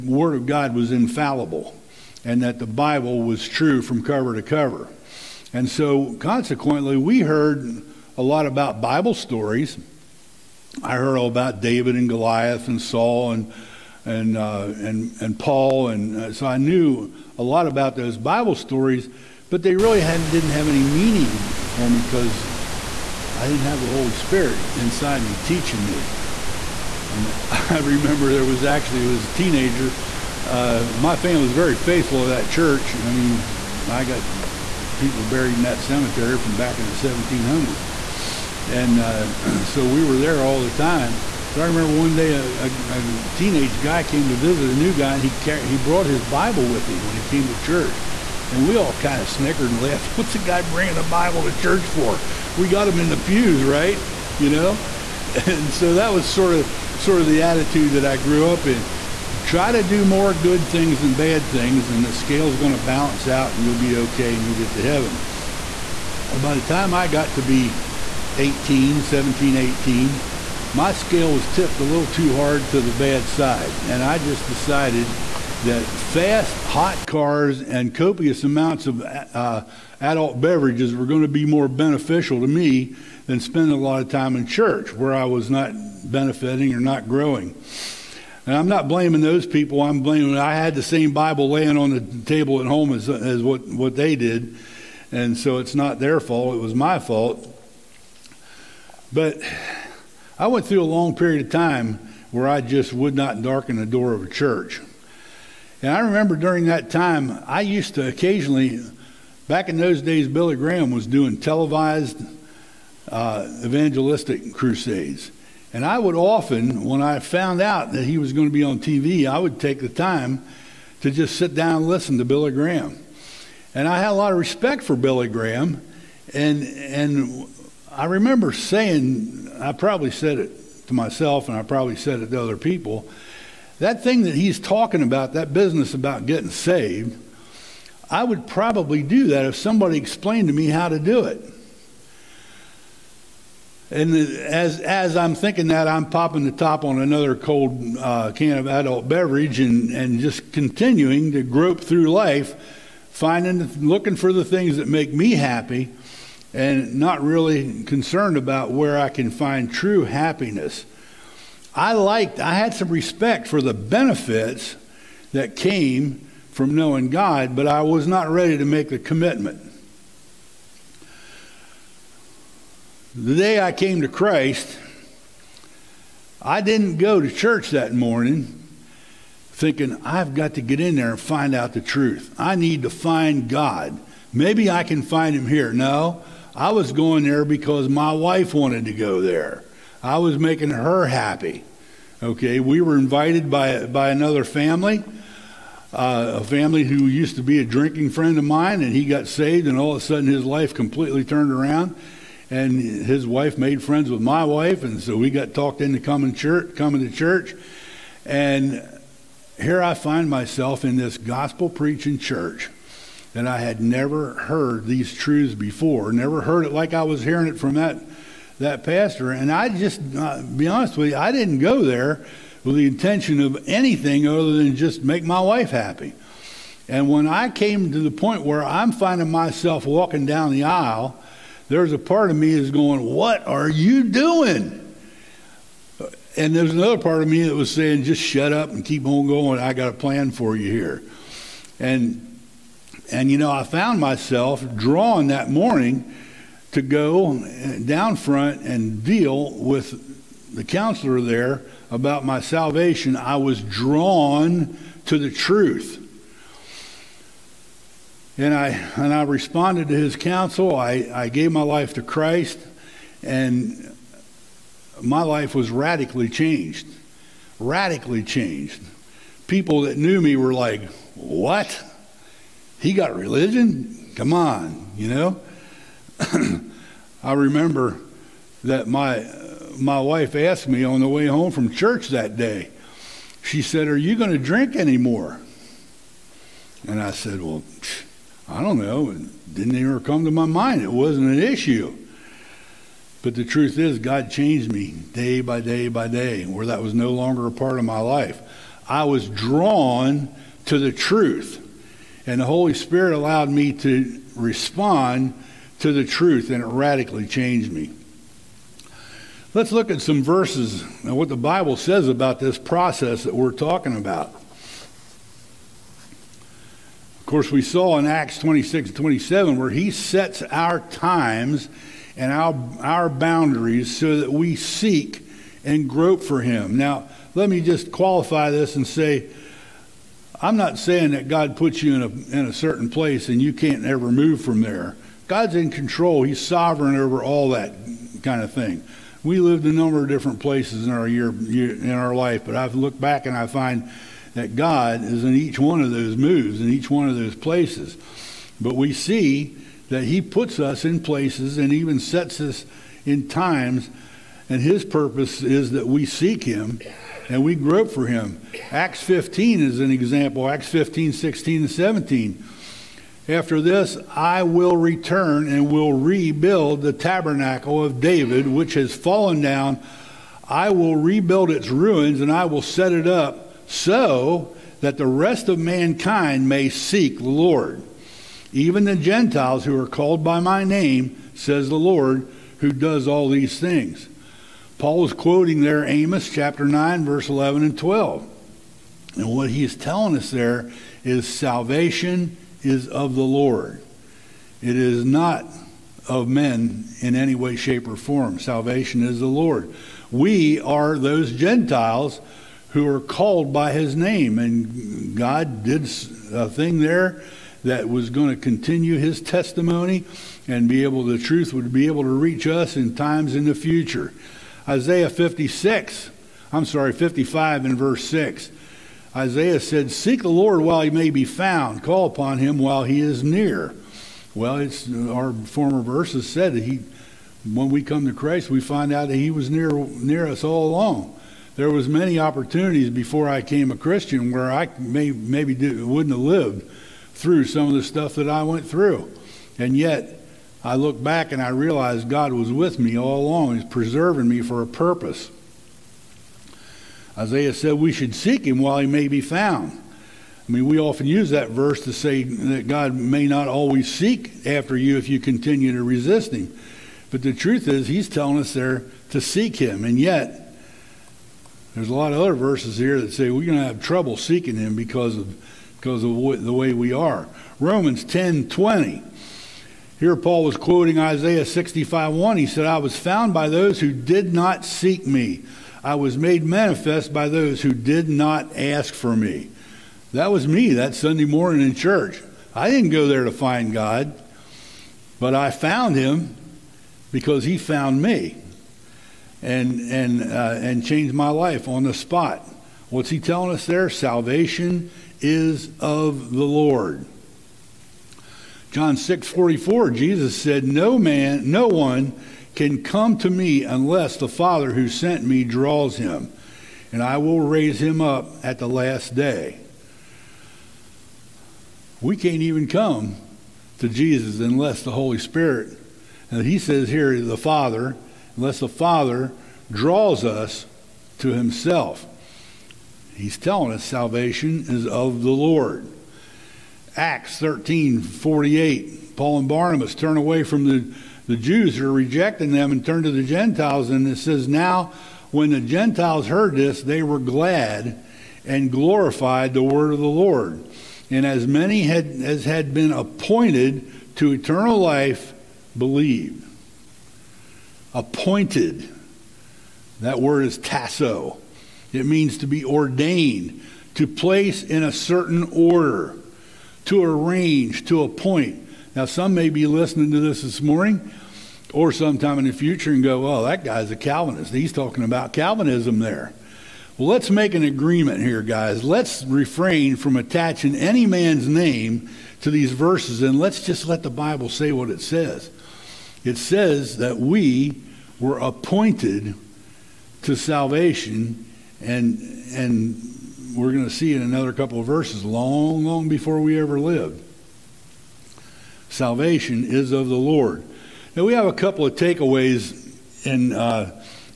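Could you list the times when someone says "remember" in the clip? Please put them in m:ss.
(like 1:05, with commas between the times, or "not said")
0:27, 0:41, 1:45, 2:08, 4:37.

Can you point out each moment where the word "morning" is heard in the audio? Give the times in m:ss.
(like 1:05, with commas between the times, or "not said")
2:57, 4:05, 8:01, 9:20.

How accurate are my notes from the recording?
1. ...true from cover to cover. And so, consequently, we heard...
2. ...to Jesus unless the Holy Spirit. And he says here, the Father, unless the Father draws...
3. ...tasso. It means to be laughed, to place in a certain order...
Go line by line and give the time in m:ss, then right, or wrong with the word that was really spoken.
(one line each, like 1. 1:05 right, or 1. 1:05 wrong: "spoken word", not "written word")
1. 0:03 right
2. 8:33 right
3. 9:10 wrong: "ordained", not "laughed".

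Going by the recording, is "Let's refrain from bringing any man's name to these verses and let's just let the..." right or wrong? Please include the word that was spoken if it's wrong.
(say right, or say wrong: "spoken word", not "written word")
wrong: "attaching", not "bringing".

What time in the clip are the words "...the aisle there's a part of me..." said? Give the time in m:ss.
3:50.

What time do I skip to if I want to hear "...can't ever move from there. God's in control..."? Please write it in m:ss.
5:33.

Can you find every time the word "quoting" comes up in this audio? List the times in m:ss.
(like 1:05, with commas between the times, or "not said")
6:25, 7:50.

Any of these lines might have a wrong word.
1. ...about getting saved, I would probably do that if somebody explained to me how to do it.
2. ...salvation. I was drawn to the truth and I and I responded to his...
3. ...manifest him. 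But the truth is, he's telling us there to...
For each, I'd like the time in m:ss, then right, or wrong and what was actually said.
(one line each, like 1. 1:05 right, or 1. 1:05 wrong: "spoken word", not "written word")
1. 2:15 right
2. 4:12 right
3. 7:35 wrong: "resist", not "manifest".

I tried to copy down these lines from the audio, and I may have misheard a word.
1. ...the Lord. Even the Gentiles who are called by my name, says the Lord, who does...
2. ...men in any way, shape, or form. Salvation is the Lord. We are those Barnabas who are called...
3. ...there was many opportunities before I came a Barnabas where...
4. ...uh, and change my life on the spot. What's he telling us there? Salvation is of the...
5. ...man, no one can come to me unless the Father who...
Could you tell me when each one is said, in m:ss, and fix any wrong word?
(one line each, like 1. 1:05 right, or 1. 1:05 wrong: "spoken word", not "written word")
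1. 6:17 right
2. 6:36 wrong: "Gentiles", not "Barnabas"
3. 7:11 wrong: "Christian", not "Barnabas"
4. 8:10 right
5. 8:20 right.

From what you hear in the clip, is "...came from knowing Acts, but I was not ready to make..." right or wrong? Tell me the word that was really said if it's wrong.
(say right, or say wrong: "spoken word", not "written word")
wrong: "God", not "Acts".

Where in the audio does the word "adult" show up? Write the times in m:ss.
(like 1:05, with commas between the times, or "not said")
1:20, 2:28.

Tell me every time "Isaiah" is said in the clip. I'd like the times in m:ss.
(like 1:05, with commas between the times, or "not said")
6:54, 6:59, 7:27, 7:50.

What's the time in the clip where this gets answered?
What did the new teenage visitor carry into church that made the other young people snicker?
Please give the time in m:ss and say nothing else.
0:46.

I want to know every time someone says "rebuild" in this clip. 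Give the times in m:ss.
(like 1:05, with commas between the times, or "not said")
6:05, 6:10.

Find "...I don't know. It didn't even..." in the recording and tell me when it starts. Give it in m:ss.
4:48.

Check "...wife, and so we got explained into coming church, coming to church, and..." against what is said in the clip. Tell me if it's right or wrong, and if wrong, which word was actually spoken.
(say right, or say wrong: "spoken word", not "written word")
wrong: "talked", not "explained".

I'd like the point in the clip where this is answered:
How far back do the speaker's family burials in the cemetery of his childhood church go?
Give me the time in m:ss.
0:36.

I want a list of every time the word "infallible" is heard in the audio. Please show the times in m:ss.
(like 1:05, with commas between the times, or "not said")
0:00.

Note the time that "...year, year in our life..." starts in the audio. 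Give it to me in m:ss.
5:41.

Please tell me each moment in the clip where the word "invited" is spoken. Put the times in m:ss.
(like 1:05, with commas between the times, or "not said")
3:12.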